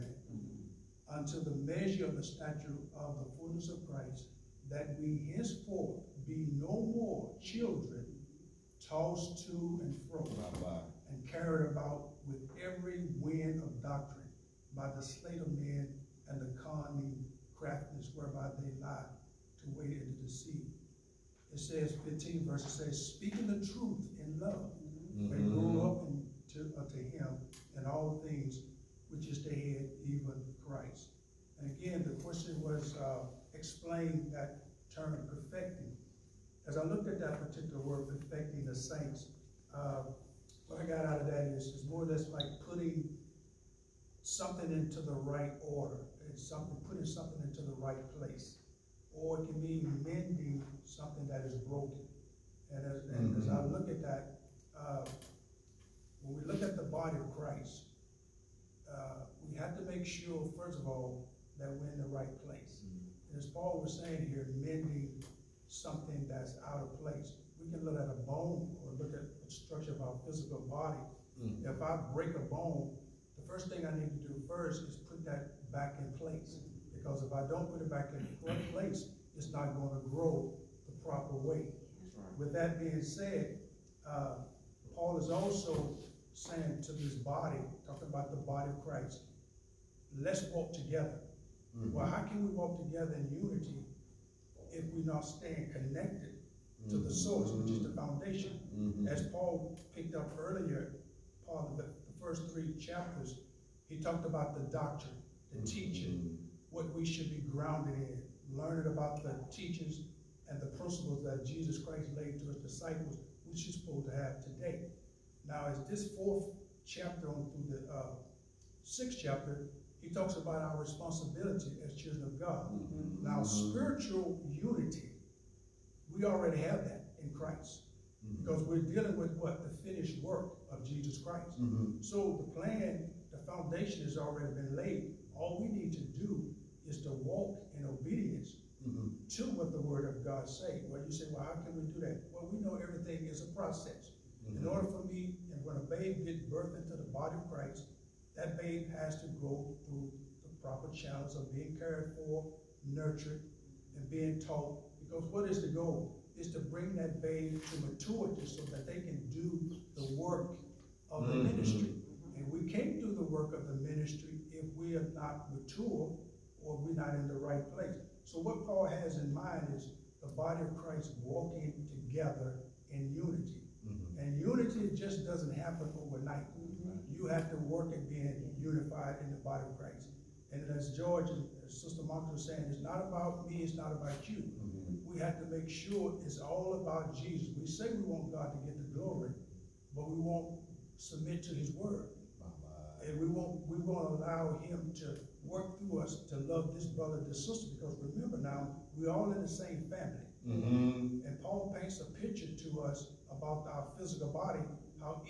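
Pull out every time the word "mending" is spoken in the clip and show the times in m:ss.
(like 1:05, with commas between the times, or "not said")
0:50, 1:04.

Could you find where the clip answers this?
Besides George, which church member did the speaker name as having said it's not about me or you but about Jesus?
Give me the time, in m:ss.
3:01.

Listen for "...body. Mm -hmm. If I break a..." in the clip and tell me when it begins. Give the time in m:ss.
1:10.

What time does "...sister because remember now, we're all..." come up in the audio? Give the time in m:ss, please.
3:17.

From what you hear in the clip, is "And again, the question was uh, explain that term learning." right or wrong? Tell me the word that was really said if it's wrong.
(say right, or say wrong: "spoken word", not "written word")
wrong: "perfecting", not "learning".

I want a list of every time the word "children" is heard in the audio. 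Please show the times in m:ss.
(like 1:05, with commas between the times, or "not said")
0:07, 2:01.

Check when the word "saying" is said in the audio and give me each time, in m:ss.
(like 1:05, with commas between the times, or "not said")
1:04, 1:26, 3:02.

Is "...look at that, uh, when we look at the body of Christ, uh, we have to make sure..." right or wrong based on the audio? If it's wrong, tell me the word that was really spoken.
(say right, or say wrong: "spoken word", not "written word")
right.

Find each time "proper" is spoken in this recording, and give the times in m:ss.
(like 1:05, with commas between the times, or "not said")
1:21, 2:30.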